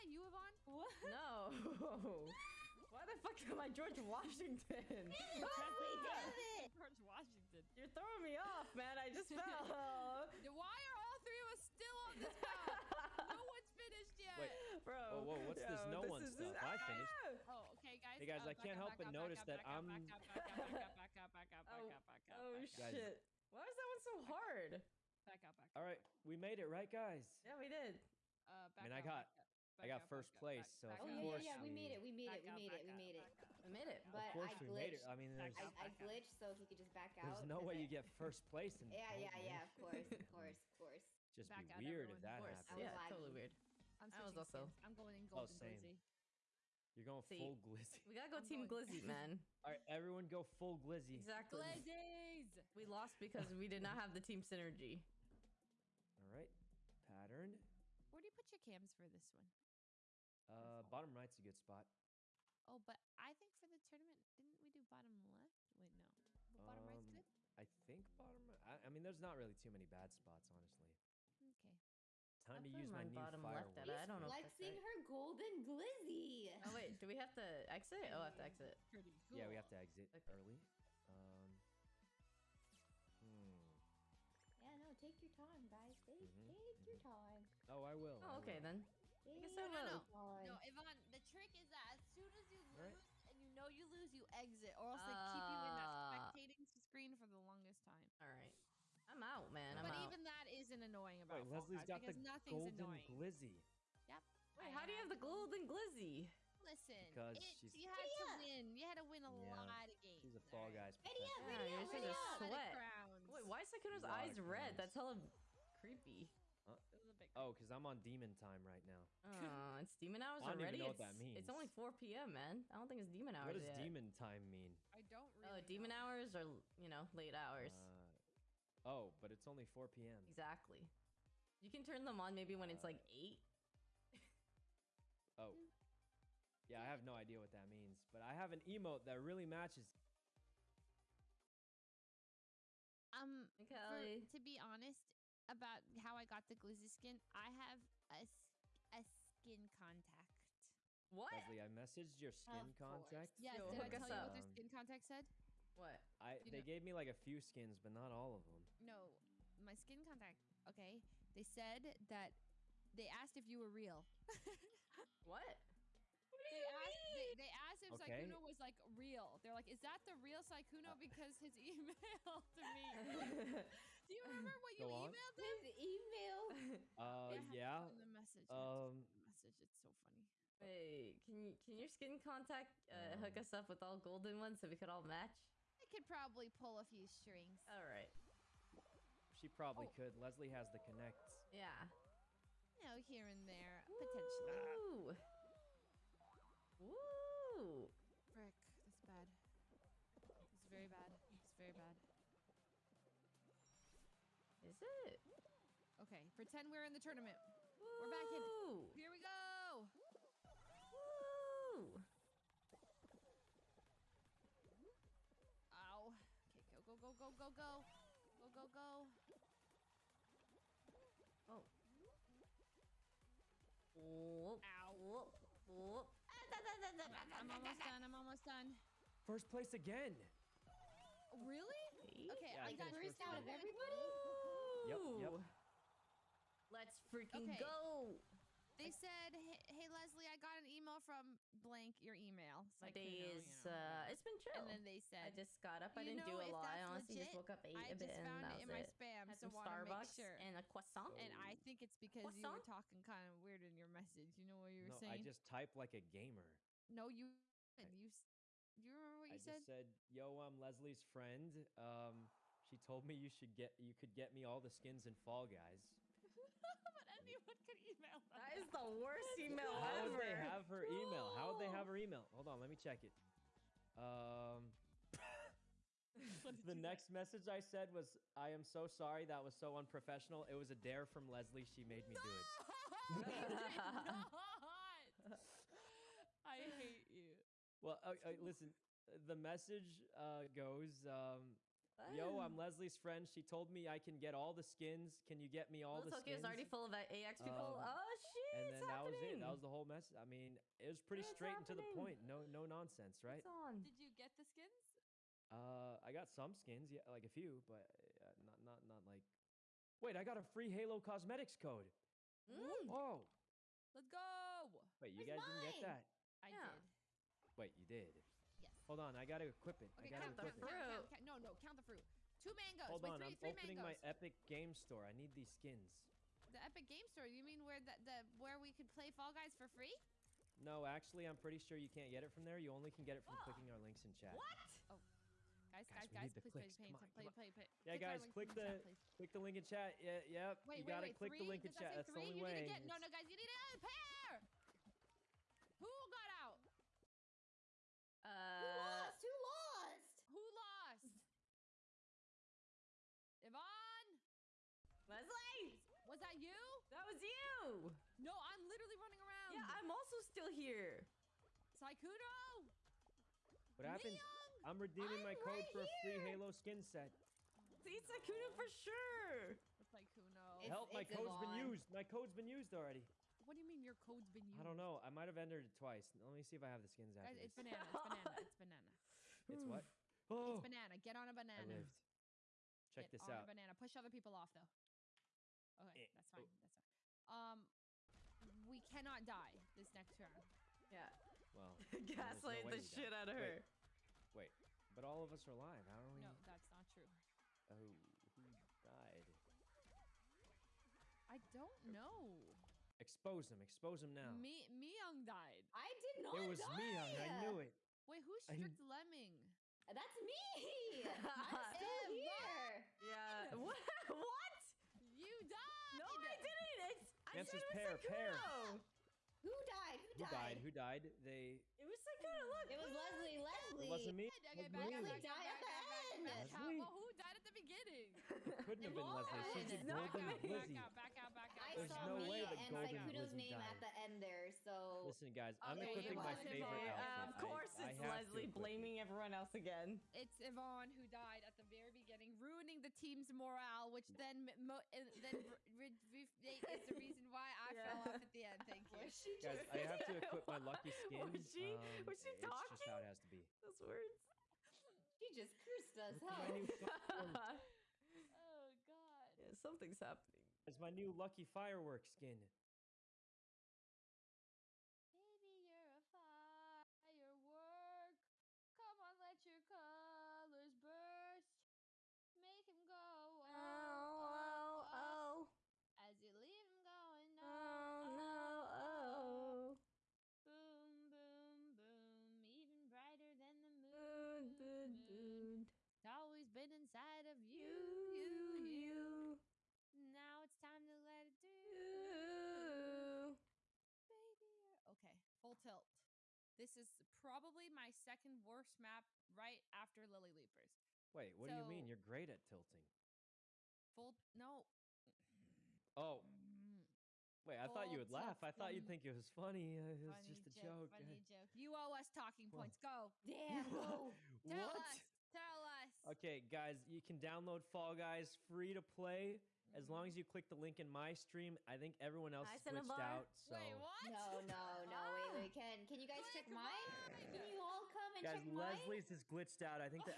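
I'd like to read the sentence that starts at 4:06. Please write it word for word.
I honestly legit, just woke up, ate a bit, and that was I just found it in my spam.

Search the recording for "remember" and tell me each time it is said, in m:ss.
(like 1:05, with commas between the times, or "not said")
2:54, 4:18.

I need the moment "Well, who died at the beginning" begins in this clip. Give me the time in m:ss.
7:06.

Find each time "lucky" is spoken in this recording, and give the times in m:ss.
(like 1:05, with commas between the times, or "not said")
7:30, 7:41.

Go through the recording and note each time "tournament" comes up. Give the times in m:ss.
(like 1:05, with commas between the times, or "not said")
1:03, 3:26.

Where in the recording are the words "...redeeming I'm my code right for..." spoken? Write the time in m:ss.
6:04.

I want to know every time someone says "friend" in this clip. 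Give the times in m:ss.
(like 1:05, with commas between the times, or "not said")
4:21, 4:52.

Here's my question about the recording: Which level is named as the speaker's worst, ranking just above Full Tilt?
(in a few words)
Lily Leapers.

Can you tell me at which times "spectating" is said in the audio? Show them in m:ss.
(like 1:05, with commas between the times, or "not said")
1:36.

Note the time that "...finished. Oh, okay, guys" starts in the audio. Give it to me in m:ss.
0:16.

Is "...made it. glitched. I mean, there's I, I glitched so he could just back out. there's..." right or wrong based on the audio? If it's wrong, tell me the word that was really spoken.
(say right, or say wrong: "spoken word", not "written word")
right.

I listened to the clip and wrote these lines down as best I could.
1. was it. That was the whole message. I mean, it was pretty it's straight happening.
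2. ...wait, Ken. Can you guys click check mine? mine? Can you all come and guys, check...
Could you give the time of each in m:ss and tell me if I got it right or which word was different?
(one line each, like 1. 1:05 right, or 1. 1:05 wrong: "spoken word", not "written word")
1. 4:59 right
2. 8:45 right.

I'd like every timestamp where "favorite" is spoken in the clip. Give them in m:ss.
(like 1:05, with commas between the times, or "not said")
7:16.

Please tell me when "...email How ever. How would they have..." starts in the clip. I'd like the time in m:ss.
4:29.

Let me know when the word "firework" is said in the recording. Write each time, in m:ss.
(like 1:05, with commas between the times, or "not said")
7:41, 7:46.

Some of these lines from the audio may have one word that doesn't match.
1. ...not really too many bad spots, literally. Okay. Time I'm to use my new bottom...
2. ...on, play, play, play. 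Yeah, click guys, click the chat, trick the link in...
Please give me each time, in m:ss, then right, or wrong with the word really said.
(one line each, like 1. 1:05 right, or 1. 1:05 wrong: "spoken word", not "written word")
1. 1:09 wrong: "honestly", not "literally"
2. 5:36 wrong: "click", not "trick".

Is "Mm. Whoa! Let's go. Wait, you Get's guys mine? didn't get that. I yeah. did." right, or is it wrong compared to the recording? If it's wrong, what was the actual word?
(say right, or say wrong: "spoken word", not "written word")
wrong: "Where", not "Get".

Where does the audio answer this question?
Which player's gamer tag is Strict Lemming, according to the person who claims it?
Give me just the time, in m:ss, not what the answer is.
6:46.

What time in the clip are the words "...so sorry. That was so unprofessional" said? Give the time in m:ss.
4:38.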